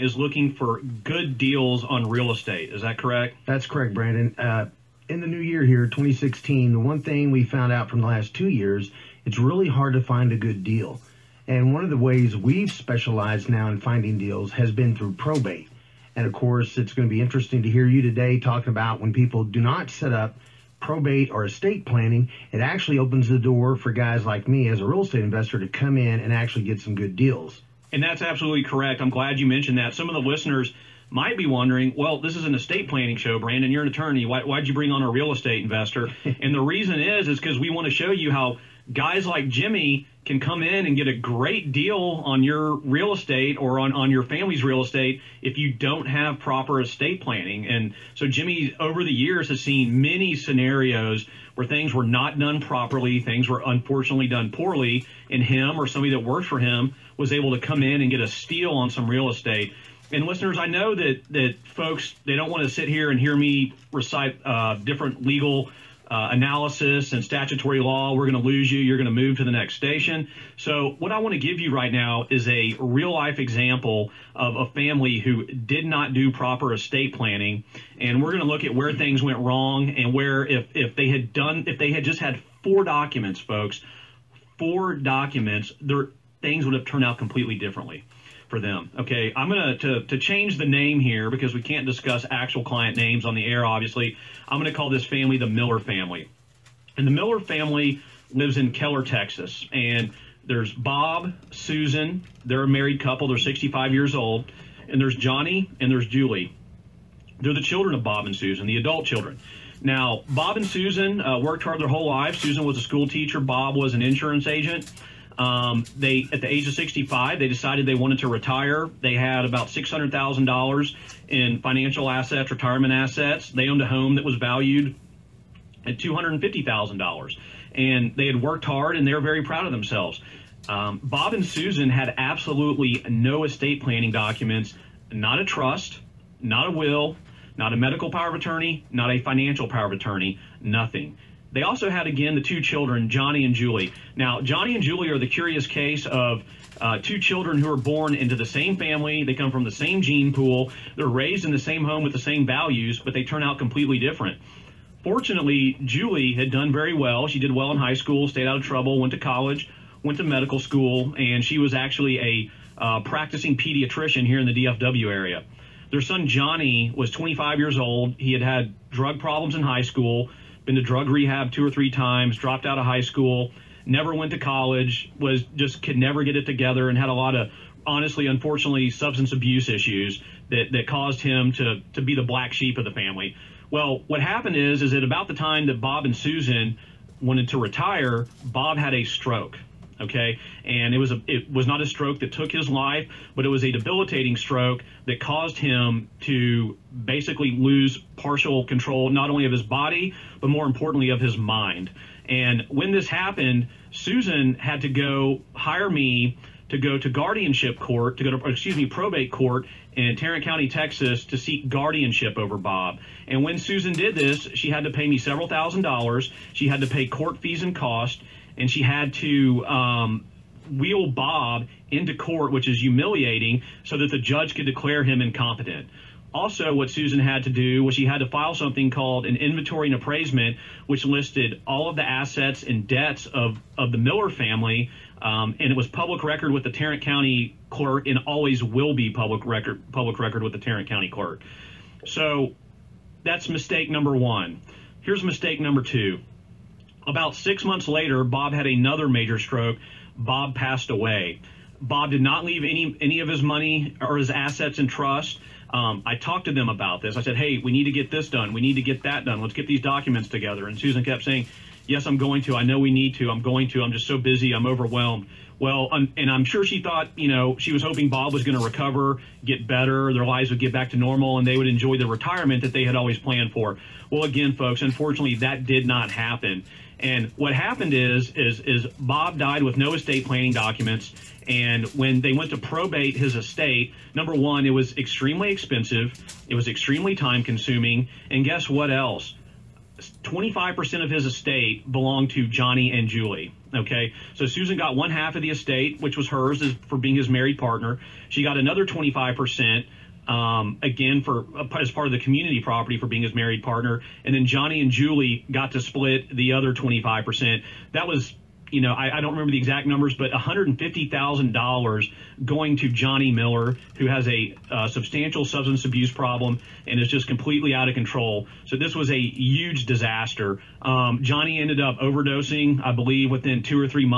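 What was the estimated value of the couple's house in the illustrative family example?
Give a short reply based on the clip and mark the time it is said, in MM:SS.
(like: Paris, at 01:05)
$250,000, at 02:05.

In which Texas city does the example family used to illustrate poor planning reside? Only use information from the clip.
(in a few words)
Keller.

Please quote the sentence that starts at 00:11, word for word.
And one of the ways we've specialized now in finding deals has been through probate.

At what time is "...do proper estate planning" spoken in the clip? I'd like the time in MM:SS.
01:16.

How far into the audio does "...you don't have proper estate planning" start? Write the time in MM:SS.
00:45.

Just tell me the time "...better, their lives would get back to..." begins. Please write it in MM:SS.
04:29.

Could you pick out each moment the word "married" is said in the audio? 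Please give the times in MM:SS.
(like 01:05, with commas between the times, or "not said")
01:42, 04:57, 05:03.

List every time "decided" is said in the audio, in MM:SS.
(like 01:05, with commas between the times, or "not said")
01:57.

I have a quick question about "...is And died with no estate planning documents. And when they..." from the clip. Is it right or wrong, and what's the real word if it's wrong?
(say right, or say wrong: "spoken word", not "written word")
wrong: "Bob", not "And".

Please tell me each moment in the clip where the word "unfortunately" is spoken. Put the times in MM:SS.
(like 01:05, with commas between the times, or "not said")
00:53, 02:58, 04:34.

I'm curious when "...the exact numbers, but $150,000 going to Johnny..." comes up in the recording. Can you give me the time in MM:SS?
05:09.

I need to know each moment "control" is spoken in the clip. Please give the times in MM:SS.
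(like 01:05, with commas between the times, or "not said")
03:18, 05:17.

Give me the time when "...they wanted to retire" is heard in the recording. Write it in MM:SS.
01:57.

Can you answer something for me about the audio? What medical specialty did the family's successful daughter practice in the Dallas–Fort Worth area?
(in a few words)
Pediatrician.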